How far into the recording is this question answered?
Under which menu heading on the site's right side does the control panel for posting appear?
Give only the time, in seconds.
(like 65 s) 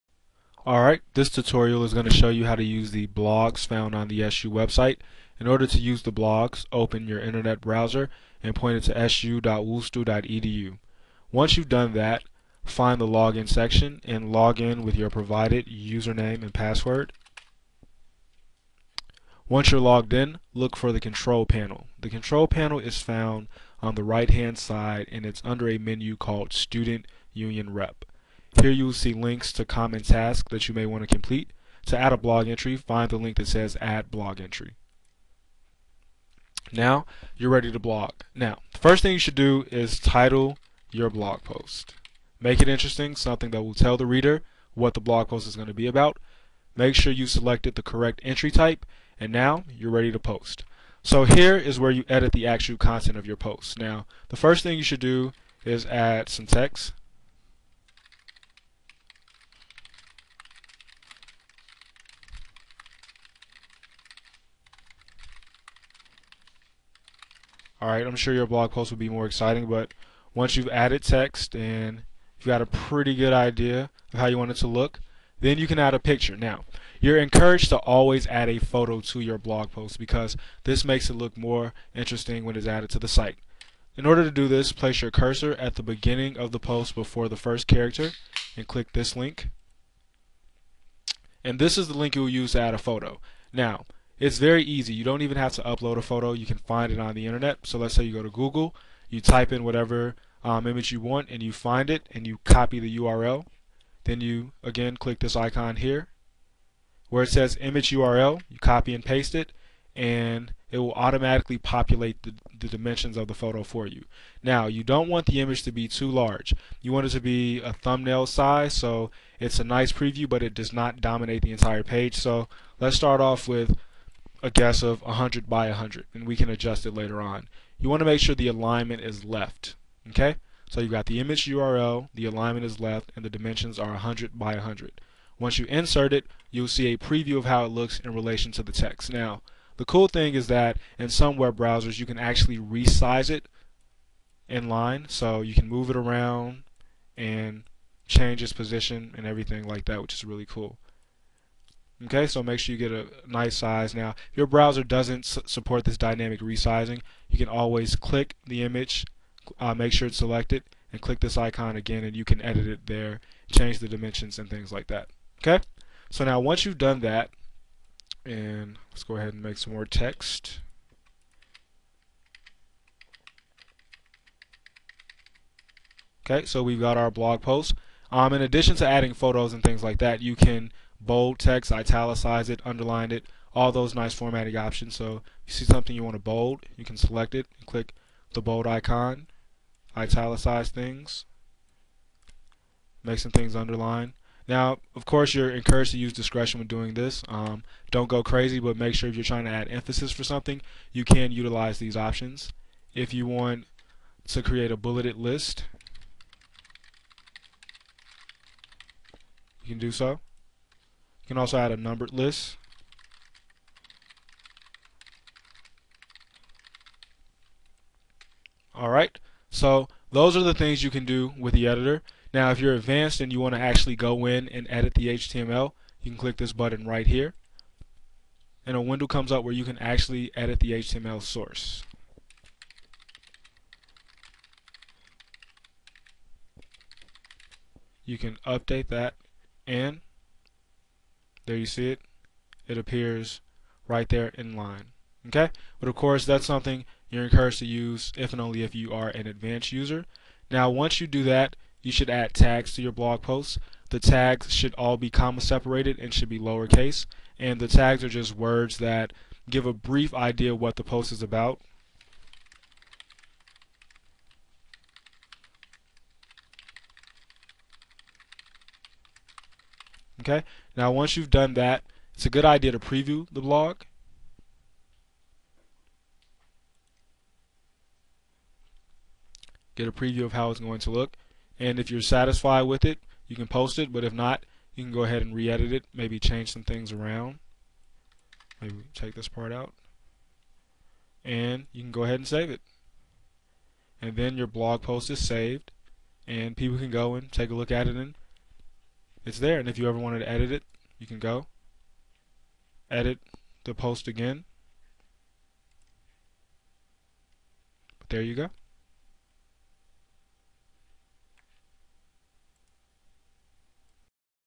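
26 s.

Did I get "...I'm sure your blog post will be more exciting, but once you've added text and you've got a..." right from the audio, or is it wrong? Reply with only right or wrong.
right.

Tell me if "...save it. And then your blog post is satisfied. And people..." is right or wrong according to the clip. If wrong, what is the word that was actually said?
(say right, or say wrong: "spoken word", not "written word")
wrong: "saved", not "satisfied".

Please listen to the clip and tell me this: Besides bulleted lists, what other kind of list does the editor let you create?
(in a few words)
numbered list.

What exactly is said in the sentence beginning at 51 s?
So here is where you edit the actual content of your post.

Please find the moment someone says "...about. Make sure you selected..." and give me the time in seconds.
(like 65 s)
45 s.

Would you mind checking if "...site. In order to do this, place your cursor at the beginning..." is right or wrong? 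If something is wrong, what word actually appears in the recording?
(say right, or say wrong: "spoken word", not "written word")
right.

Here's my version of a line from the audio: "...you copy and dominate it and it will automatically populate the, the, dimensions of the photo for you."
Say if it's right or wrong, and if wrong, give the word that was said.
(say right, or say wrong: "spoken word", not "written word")
wrong: "paste", not "dominate".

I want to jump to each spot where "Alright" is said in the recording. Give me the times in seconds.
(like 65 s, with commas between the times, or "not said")
0 s, 218 s.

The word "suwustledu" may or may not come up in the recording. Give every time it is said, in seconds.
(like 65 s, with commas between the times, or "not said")
9 s.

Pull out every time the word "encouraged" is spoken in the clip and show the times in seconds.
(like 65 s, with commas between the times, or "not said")
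77 s, 195 s, 247 s.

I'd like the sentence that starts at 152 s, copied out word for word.
Okay, so make sure you get a nice size.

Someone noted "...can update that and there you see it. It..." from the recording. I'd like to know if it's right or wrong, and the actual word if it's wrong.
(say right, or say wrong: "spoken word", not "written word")
right.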